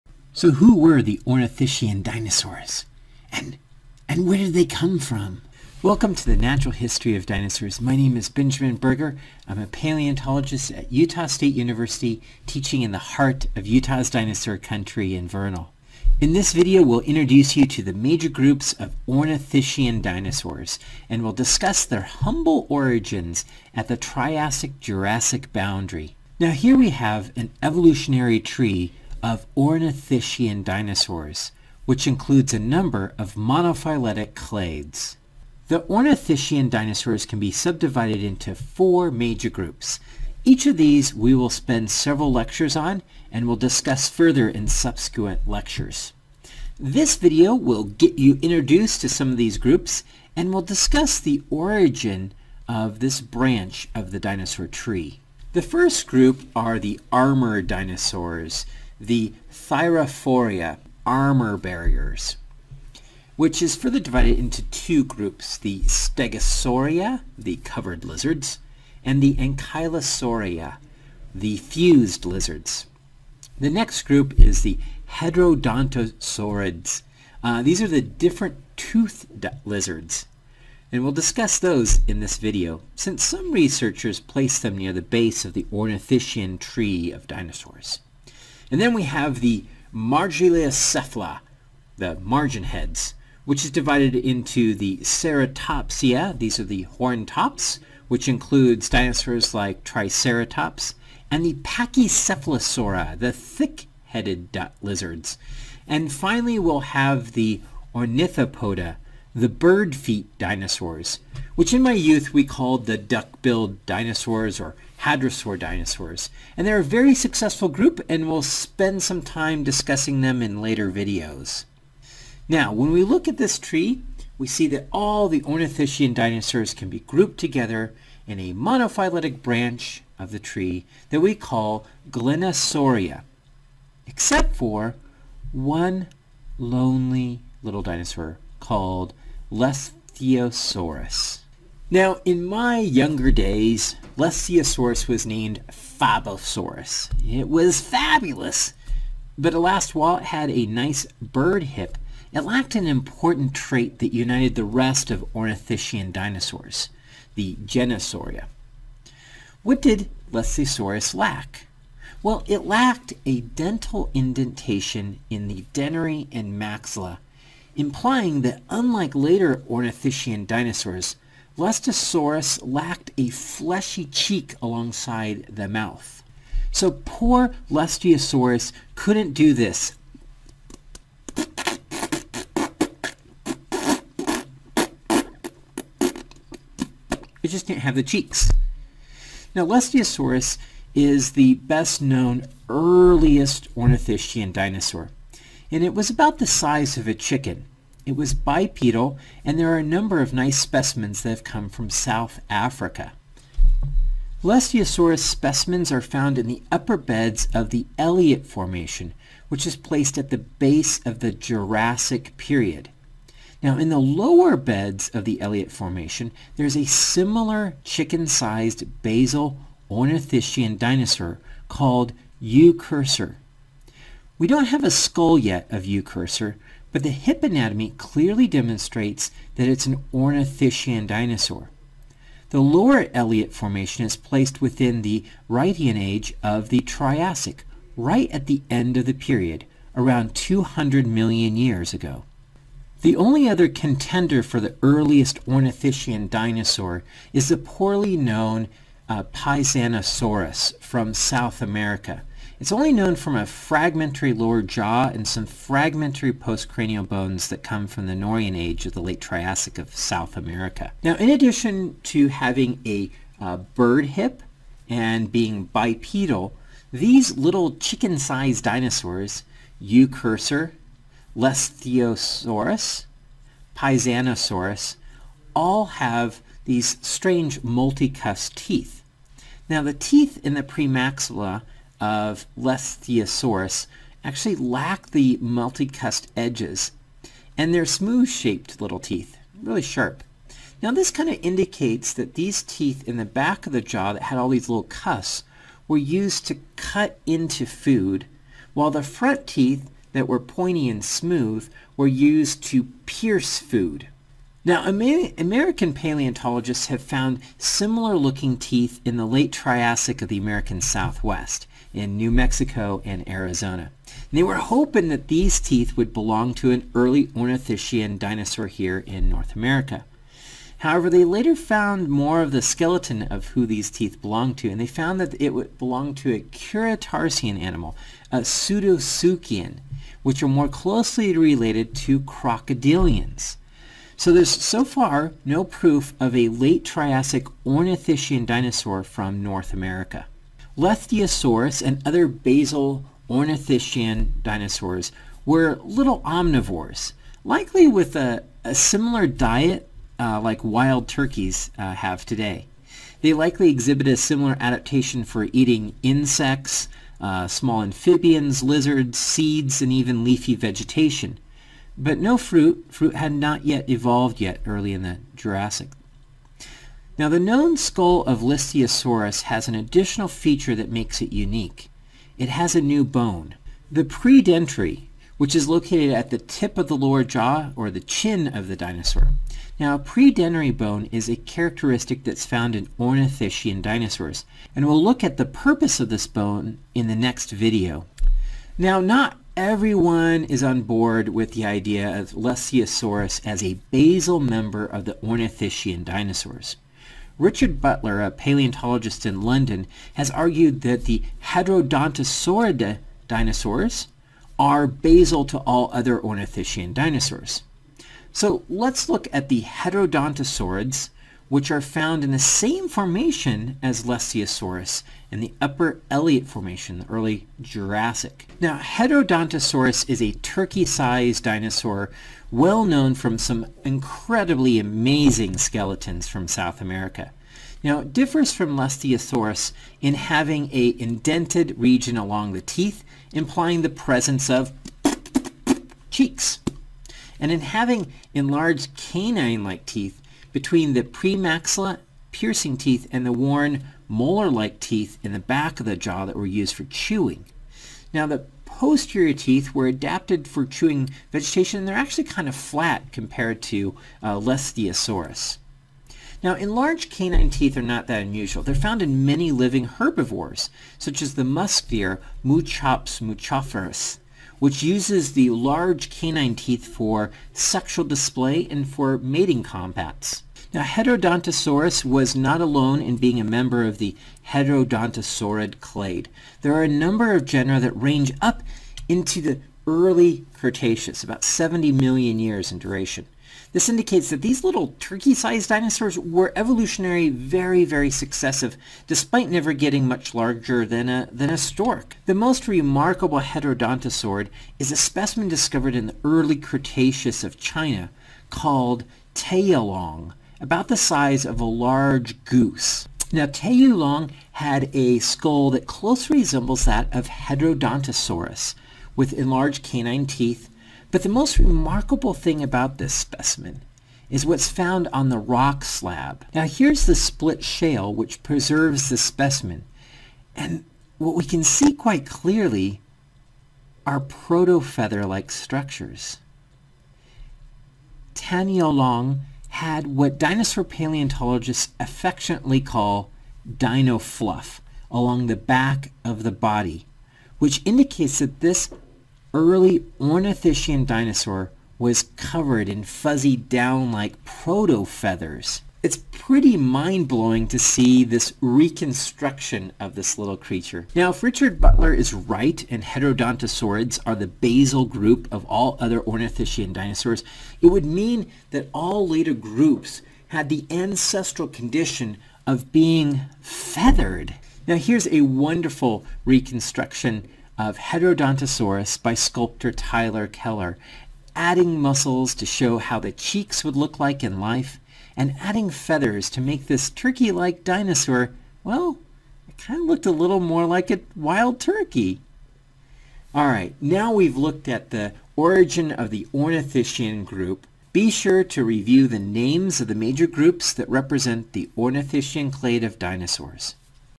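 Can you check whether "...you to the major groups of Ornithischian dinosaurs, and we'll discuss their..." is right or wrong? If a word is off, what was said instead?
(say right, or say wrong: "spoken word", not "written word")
right.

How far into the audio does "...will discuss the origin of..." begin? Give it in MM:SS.
00:50.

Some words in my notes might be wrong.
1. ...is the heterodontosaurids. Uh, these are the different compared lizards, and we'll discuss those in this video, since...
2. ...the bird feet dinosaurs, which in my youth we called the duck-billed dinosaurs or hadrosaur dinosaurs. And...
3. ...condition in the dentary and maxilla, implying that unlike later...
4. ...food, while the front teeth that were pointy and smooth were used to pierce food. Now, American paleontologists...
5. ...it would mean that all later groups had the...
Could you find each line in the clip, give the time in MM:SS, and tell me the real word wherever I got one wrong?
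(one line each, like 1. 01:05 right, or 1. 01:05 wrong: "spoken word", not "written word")
1. 01:14 wrong: "toothed", not "compared"
2. 01:49 right
3. 02:44 wrong: "indentation", not "condition"
4. 04:57 right
5. 09:17 right.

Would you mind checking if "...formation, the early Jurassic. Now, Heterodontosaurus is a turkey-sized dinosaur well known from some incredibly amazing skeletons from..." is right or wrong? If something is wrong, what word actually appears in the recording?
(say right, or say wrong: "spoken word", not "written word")
right.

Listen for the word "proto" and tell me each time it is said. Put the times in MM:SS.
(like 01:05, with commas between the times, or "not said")
08:44, 09:04.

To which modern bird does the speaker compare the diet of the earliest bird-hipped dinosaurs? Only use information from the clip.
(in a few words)
wild turkeys.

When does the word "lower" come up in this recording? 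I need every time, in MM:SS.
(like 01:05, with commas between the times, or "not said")
03:33, 03:52, 04:14, 06:16.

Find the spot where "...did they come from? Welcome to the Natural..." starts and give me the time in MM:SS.
00:04.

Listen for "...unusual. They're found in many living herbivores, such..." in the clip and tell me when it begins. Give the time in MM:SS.
07:38.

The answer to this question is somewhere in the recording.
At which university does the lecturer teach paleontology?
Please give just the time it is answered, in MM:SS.
00:10.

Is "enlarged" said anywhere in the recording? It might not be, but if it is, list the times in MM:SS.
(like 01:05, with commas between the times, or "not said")
07:18, 07:36, 08:29.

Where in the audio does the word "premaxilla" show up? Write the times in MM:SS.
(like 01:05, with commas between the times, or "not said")
04:40, 07:21.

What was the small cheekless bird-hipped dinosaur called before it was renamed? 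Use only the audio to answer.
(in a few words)
Fabosaurus.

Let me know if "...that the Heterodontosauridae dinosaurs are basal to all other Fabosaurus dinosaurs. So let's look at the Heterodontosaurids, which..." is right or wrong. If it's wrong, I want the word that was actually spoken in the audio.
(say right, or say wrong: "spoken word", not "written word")
wrong: "Ornithischian", not "Fabosaurus".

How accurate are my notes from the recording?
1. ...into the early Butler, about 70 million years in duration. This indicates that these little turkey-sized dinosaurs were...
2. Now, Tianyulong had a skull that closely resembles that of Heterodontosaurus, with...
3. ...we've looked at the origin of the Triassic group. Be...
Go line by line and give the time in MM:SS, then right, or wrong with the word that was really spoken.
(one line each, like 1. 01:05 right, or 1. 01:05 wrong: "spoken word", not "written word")
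1. 07:59 wrong: "Cretaceous", not "Butler"
2. 08:23 right
3. 09:44 wrong: "Ornithischian", not "Triassic".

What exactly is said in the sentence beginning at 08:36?
Now here's the split shale which preserves the specimen.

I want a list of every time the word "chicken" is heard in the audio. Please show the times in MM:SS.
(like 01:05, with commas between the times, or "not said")
03:17, 03:37, 04:27.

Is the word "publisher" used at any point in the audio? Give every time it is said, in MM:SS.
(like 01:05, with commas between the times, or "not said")
not said.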